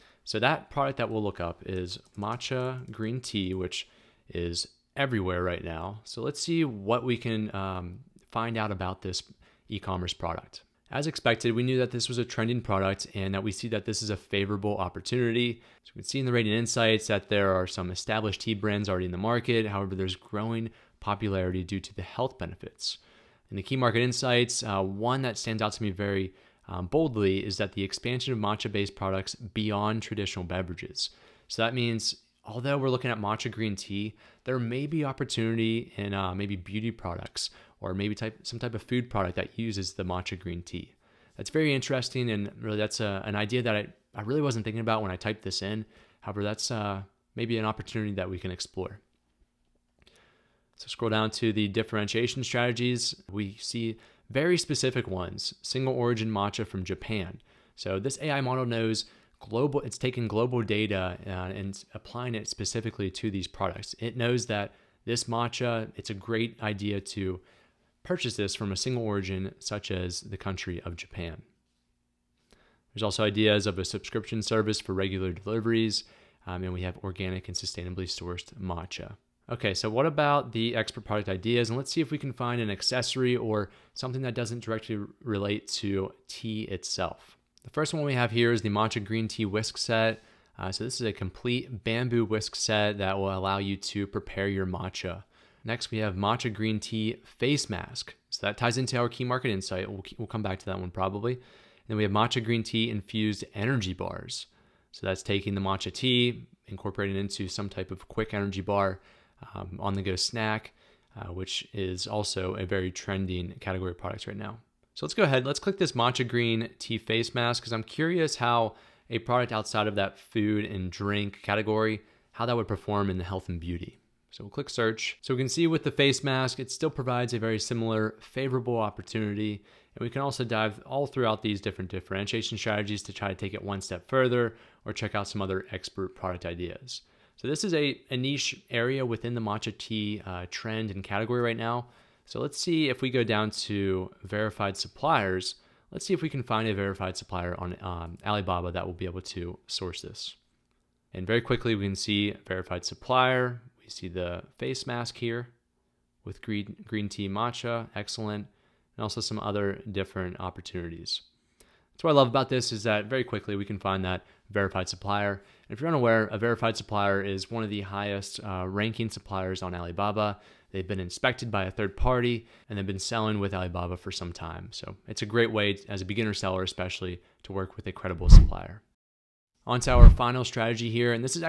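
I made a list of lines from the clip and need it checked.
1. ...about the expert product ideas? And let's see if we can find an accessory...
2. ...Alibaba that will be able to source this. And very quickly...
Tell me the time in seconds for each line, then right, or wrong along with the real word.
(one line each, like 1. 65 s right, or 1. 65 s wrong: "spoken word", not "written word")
1. 80 s right
2. 148 s right.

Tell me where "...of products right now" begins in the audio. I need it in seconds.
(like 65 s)
113 s.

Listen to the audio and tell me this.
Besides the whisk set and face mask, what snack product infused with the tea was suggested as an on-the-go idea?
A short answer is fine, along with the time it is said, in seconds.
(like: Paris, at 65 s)
Energy bars, at 103 s.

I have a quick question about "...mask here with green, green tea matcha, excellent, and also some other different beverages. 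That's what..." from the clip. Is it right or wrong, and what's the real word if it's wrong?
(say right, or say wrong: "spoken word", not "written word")
wrong: "opportunities", not "beverages".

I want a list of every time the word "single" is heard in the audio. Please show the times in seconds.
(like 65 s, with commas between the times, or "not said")
55 s, 68 s.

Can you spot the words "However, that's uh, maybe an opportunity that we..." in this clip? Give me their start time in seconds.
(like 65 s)
46 s.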